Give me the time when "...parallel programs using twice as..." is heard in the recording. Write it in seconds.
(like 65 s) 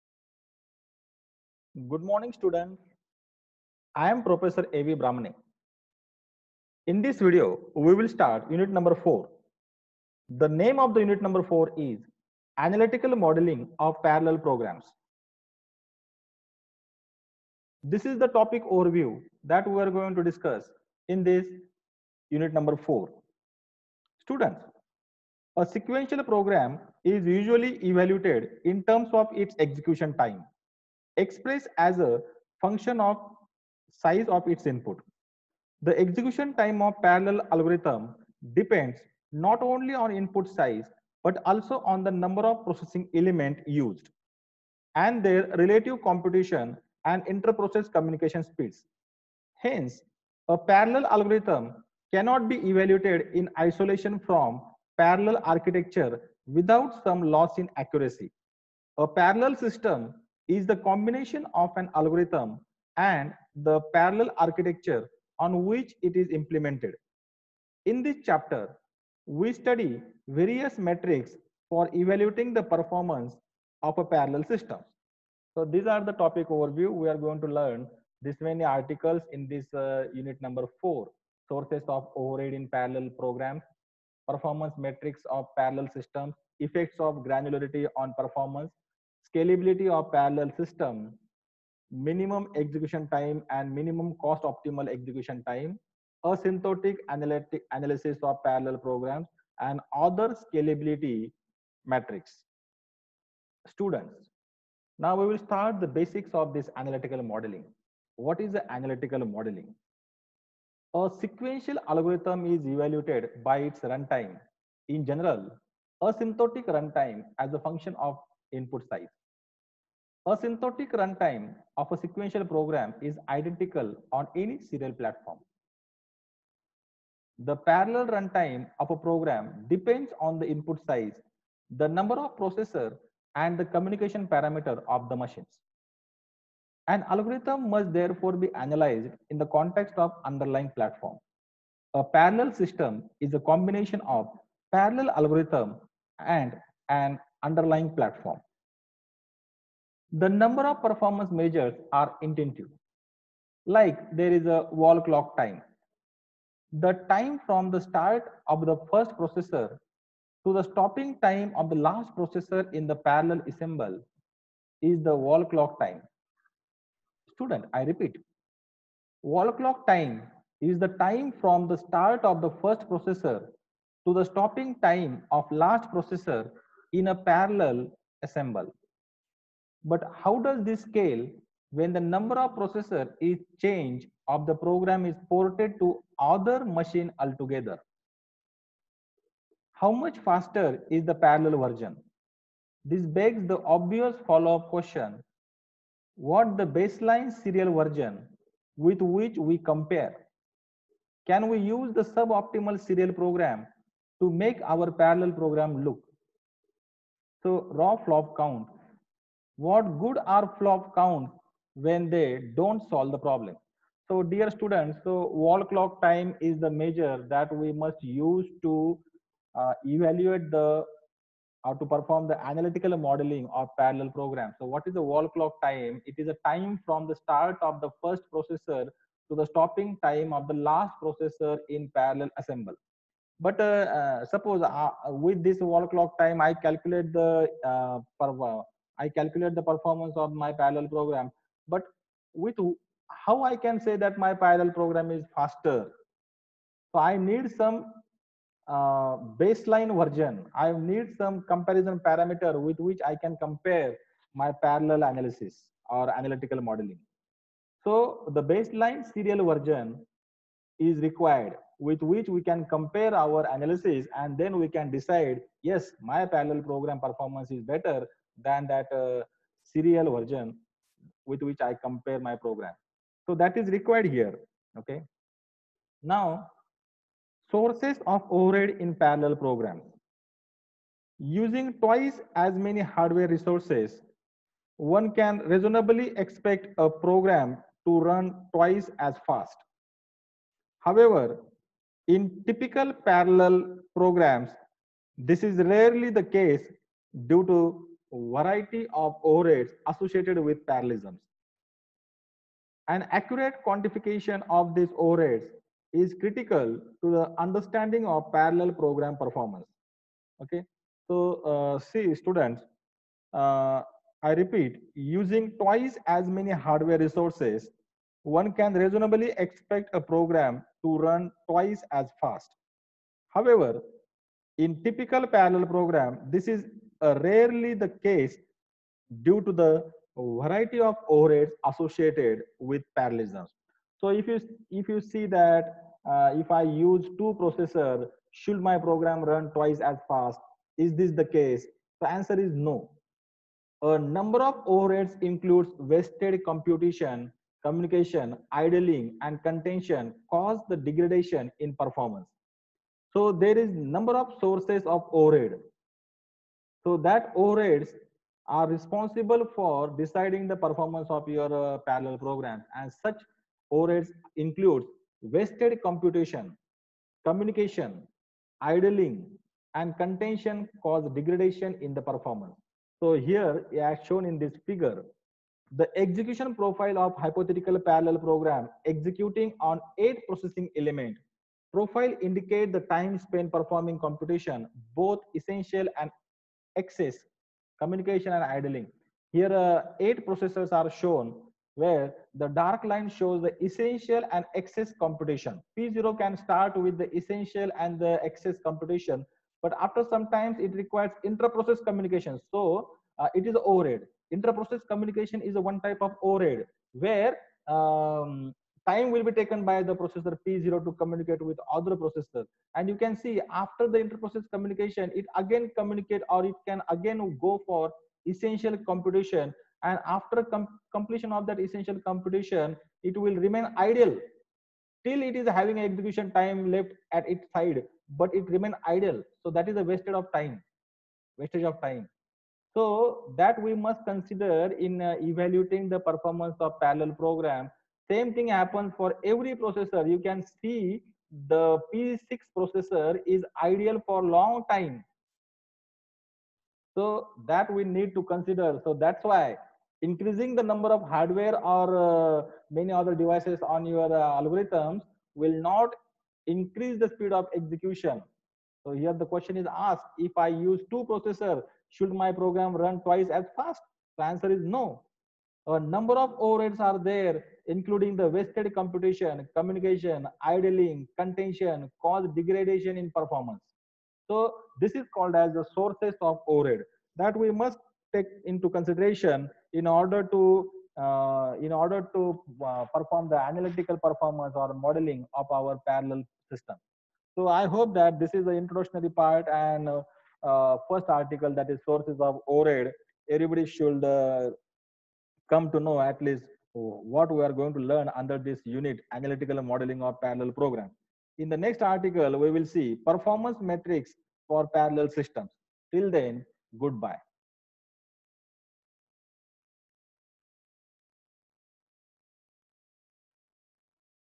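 279 s.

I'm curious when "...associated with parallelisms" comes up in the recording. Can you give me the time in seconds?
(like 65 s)
299 s.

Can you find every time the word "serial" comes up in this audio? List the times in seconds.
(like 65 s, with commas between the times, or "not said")
124 s, 197 s, 202 s, 259 s, 269 s.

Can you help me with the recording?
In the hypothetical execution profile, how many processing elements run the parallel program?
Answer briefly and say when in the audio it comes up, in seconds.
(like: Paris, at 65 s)
8, at 379 s.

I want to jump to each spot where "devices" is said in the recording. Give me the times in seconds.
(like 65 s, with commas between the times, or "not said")
453 s.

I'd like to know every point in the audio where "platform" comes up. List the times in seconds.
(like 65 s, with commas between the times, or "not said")
124 s, 140 s, 147 s.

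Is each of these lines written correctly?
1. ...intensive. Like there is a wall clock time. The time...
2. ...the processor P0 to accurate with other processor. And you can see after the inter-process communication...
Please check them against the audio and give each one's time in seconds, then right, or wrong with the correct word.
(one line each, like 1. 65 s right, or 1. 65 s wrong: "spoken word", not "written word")
1. 152 s right
2. 409 s wrong: "communicate", not "accurate".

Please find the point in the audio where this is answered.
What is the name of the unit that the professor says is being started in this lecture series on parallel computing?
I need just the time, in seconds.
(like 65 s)
12 s.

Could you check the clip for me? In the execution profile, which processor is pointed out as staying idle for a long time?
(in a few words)
P6.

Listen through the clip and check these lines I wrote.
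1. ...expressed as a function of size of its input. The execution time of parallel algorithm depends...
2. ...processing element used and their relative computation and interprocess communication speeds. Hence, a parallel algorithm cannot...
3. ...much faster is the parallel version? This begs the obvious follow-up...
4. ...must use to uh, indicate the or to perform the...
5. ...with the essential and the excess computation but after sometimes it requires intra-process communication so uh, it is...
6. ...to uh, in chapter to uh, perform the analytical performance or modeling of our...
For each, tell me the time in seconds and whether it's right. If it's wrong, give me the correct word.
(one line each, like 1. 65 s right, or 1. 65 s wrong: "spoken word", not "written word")
1. 31 s right
2. 42 s right
3. 189 s right
4. 217 s wrong: "evaluate", not "indicate"
5. 396 s right
6. 480 s wrong: "order", not "chapter".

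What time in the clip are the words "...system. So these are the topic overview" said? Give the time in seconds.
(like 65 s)
74 s.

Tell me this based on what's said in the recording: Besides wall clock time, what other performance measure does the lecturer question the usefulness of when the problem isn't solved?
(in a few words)
raw flop count.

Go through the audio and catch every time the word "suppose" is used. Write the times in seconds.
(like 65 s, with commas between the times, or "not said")
234 s.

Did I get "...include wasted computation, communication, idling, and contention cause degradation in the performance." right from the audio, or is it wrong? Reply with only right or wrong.
right.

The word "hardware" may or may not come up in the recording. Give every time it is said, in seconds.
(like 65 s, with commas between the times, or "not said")
282 s, 316 s, 451 s.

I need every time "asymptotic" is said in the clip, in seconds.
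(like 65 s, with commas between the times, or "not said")
96 s, 116 s, 120 s.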